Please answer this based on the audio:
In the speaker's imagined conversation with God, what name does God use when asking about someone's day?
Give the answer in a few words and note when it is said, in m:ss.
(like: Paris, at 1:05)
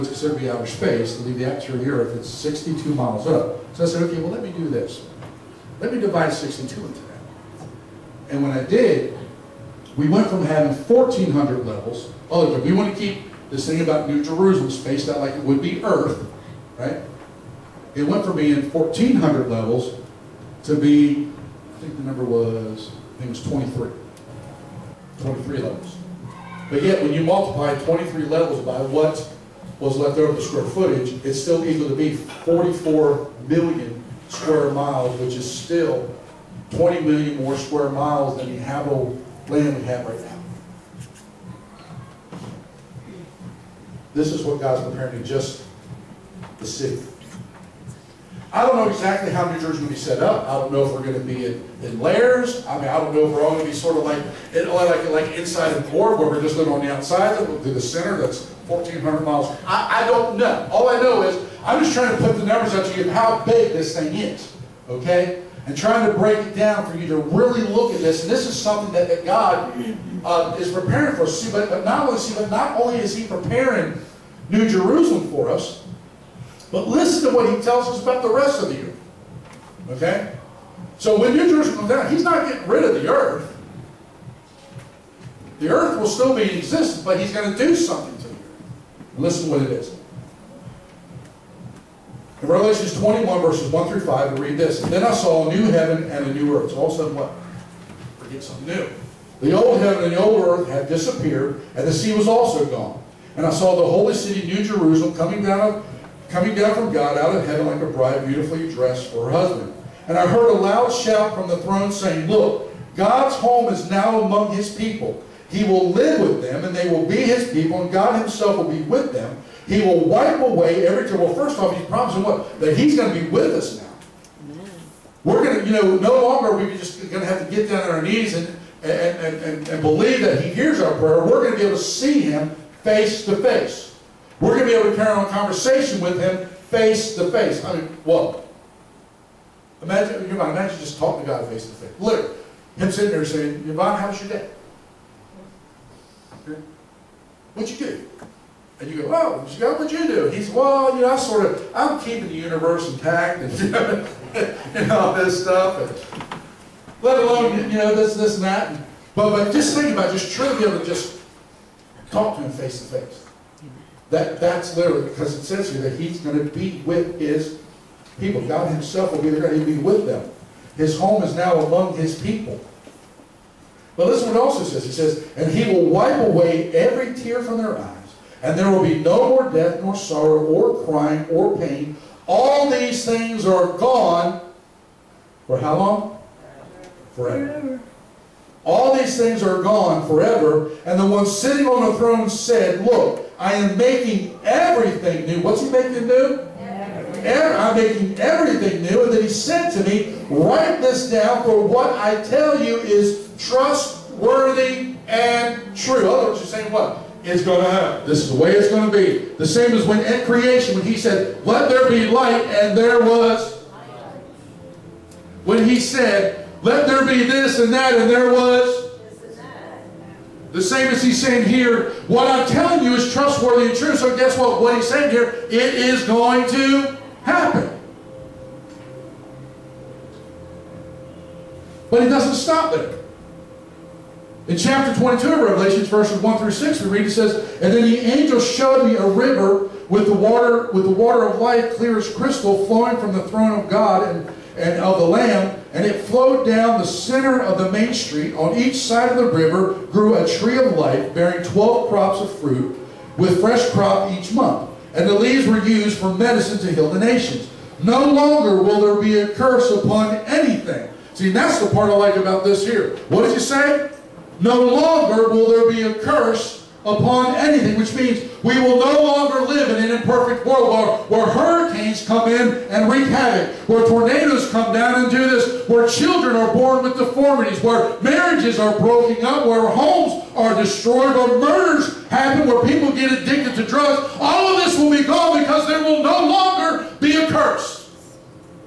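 Yvonne, at 2:23.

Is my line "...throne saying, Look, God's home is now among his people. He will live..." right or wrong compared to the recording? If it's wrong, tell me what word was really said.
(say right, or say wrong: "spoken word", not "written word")
right.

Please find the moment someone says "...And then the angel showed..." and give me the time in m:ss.
3:57.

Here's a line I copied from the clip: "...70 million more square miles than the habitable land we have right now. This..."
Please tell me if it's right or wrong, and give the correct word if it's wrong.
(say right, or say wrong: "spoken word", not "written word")
wrong: "20", not "70".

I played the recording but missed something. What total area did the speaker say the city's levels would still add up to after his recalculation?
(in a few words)
44 million square miles.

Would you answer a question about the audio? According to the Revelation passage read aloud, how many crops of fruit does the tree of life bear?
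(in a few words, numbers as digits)
12.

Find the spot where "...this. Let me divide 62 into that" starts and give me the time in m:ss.
0:04.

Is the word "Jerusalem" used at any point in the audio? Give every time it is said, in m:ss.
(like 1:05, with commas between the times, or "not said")
0:14, 1:14, 1:21, 1:44.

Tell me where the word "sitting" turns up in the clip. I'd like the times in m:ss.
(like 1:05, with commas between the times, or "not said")
2:22, 3:11.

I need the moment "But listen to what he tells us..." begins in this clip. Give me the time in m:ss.
1:16.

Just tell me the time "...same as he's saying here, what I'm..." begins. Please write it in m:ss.
3:40.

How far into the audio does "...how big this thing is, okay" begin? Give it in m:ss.
1:03.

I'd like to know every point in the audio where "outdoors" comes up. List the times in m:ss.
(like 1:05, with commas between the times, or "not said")
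not said.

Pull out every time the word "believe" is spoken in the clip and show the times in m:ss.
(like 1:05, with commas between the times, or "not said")
2:09.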